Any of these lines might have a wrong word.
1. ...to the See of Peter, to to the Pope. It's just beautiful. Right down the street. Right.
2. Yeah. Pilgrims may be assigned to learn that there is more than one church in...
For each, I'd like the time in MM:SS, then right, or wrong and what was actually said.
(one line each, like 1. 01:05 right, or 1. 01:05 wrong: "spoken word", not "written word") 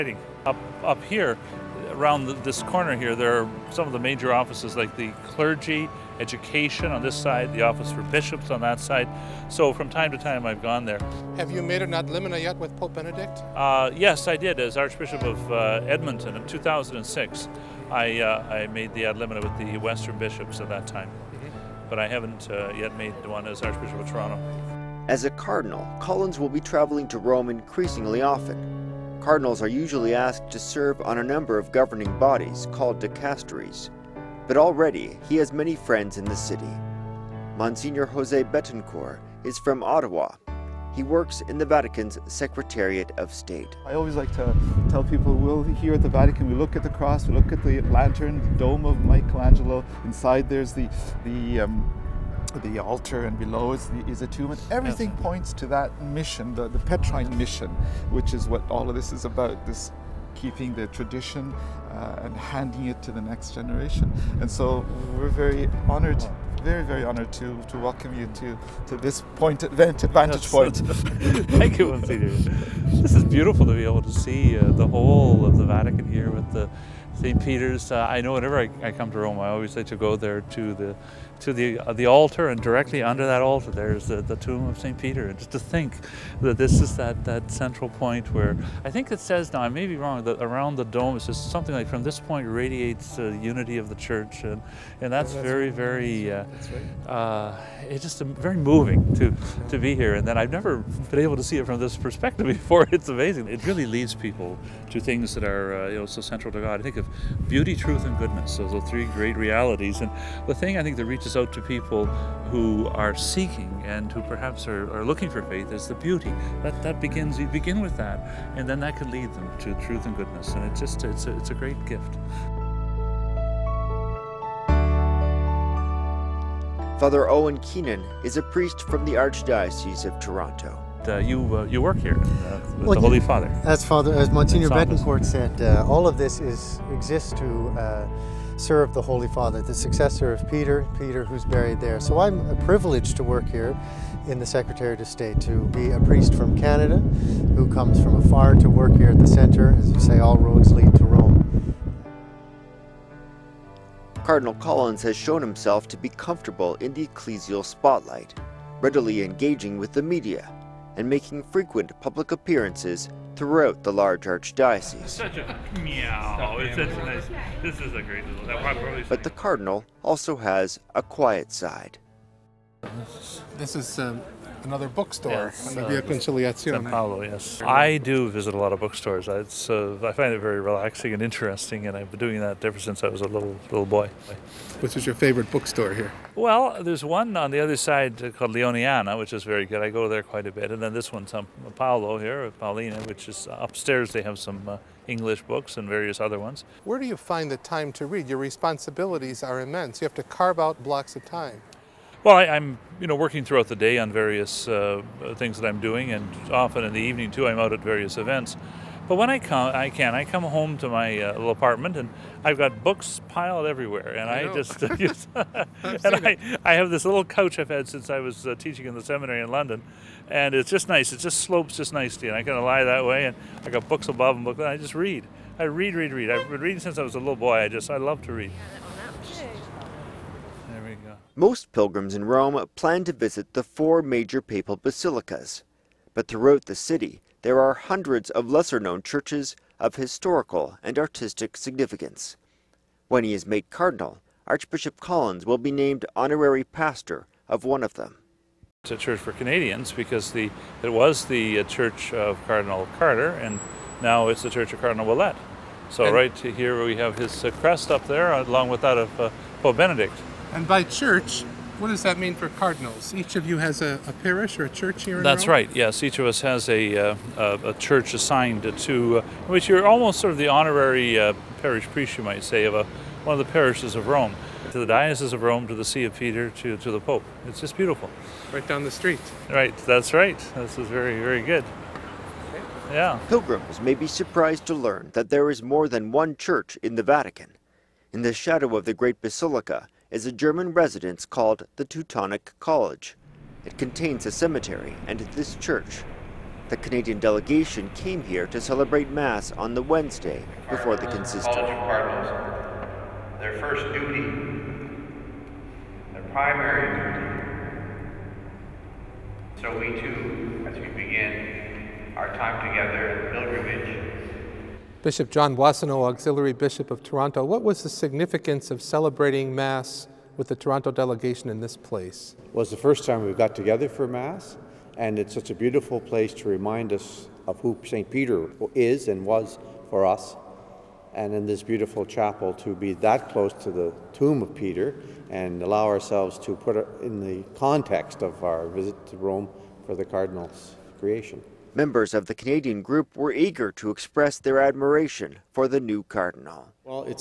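1. 04:35 right
2. 04:42 wrong: "surprised", not "assigned".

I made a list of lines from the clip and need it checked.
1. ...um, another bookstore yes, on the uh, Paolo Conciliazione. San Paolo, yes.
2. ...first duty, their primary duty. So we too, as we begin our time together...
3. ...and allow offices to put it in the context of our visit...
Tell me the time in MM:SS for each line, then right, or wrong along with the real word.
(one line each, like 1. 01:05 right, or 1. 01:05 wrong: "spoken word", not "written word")
1. 02:53 wrong: "Via", not "Paolo"
2. 05:03 right
3. 05:35 wrong: "ourselves", not "offices".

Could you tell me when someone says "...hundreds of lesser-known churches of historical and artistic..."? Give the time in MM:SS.
03:57.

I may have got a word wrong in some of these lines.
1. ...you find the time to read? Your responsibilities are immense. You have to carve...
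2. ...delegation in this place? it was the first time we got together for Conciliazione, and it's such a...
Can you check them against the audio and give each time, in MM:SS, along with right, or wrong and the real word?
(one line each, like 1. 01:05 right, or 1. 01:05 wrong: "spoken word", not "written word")
1. 03:17 right
2. 05:20 wrong: "Mass", not "Conciliazione".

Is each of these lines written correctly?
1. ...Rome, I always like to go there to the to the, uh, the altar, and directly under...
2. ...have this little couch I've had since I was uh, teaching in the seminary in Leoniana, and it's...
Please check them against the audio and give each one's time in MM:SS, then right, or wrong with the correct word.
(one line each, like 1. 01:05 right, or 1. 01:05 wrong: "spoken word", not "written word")
1. 01:19 right
2. 03:36 wrong: "London", not "Leoniana".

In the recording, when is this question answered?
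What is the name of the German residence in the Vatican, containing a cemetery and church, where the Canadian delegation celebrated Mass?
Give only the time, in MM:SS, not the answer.
04:51.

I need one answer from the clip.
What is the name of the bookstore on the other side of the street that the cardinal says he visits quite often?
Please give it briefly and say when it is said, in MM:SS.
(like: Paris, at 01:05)
Leoniana, at 03:08.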